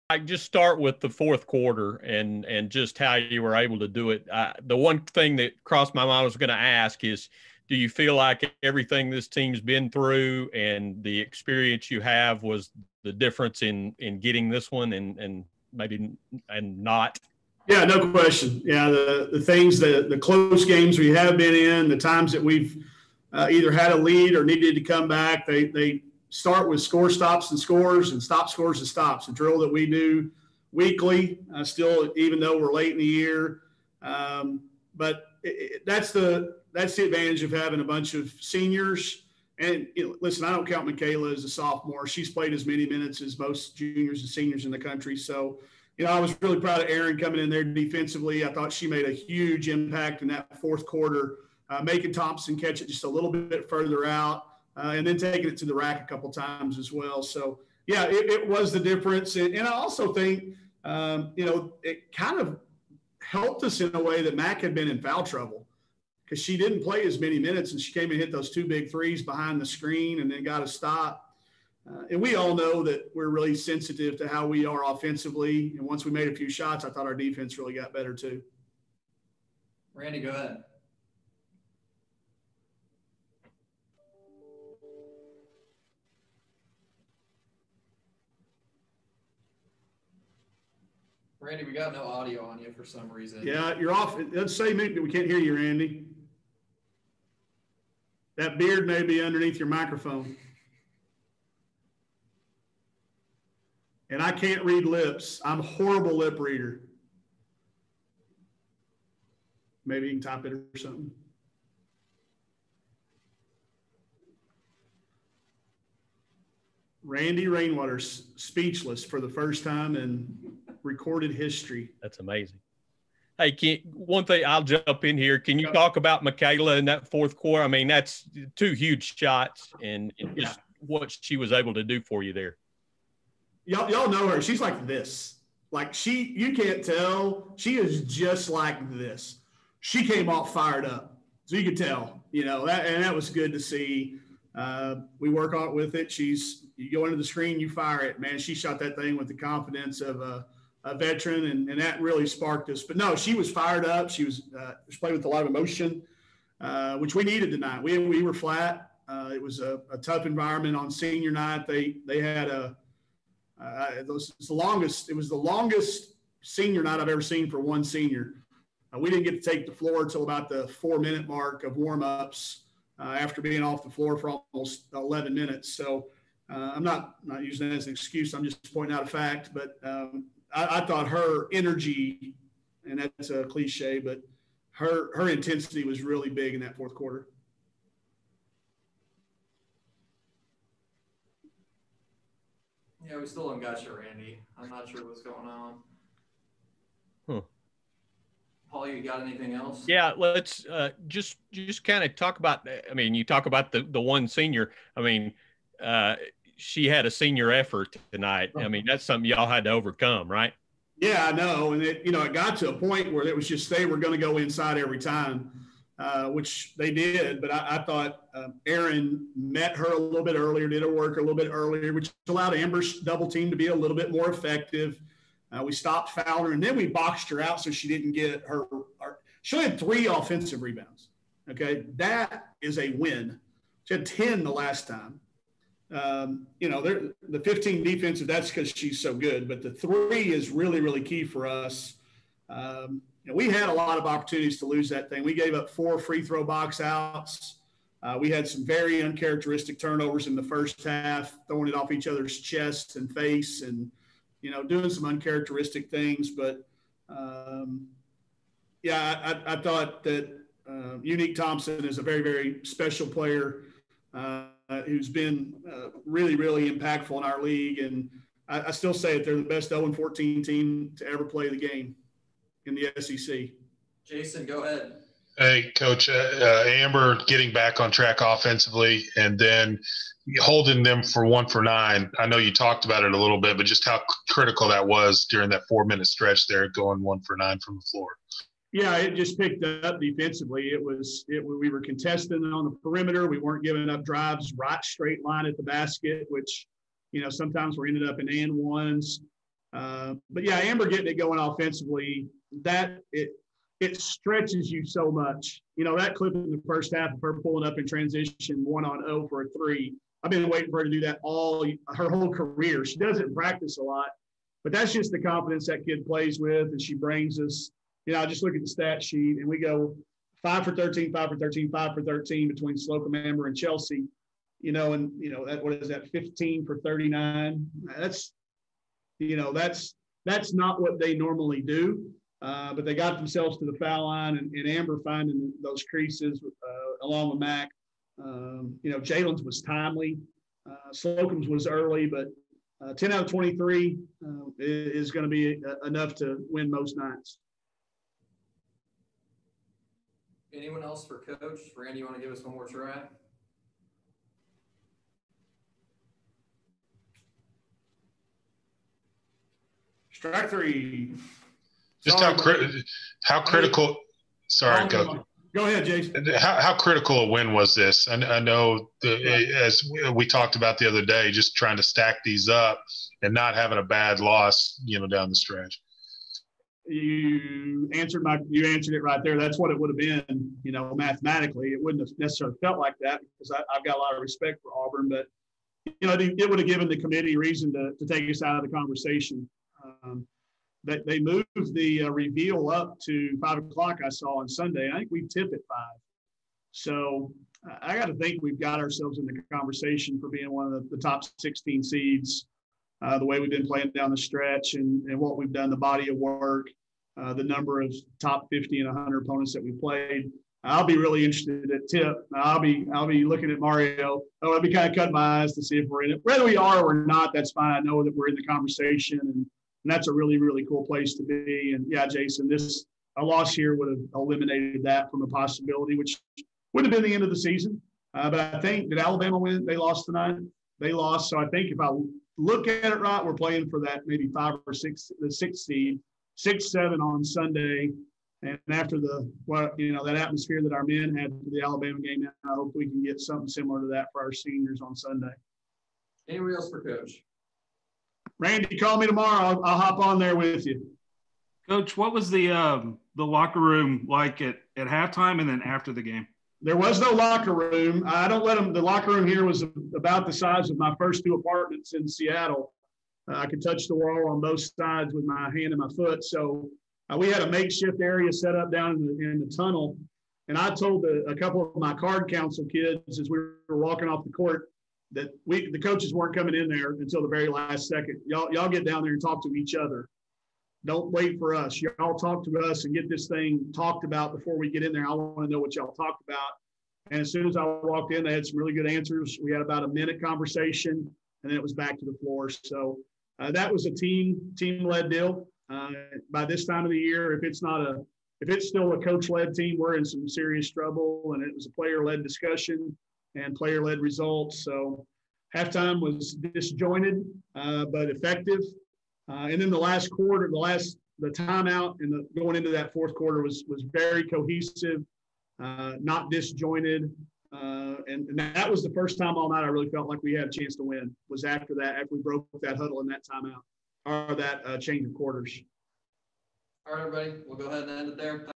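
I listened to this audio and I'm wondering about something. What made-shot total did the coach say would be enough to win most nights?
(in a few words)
10 out of 23.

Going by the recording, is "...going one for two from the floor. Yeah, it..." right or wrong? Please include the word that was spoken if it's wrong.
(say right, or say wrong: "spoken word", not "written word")
wrong: "nine", not "two".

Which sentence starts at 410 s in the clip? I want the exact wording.
I'll be really interested at tip.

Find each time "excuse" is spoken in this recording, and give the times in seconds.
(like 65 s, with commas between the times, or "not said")
177 s.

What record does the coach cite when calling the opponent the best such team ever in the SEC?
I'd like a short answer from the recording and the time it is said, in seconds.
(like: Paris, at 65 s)
0-14, at 269 s.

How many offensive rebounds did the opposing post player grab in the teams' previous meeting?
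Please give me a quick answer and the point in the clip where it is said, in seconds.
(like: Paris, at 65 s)
10, at 234 s.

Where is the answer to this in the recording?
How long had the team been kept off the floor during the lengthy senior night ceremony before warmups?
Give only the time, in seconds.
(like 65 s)
174 s.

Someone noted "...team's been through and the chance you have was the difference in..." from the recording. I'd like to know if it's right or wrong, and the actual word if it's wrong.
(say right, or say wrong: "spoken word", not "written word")
wrong: "experience", not "chance".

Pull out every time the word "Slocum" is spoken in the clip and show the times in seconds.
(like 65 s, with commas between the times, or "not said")
322 s, 340 s.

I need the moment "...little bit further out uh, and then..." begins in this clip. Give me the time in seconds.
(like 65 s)
53 s.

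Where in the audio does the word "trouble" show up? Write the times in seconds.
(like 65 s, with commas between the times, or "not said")
65 s, 500 s.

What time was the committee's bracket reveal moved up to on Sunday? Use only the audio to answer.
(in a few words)
5 o'clock.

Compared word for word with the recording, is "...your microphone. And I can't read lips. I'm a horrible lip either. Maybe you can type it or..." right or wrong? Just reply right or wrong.
wrong.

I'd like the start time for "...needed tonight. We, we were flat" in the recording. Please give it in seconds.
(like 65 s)
157 s.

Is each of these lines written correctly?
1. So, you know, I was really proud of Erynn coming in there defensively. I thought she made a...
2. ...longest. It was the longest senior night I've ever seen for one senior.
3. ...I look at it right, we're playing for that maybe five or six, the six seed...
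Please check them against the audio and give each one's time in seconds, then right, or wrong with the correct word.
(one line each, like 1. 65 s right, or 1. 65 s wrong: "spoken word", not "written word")
1. 45 s right
2. 164 s right
3. 431 s right.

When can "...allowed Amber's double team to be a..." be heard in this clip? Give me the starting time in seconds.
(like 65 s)
222 s.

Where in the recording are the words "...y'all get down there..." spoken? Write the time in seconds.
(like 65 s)
478 s.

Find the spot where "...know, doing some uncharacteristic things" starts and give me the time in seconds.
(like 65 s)
254 s.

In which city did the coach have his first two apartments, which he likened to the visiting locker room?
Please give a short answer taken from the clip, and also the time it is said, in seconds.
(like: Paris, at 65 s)
Seattle, at 462 s.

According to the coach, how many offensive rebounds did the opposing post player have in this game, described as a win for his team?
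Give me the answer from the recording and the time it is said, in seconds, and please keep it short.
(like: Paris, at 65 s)
3, at 229 s.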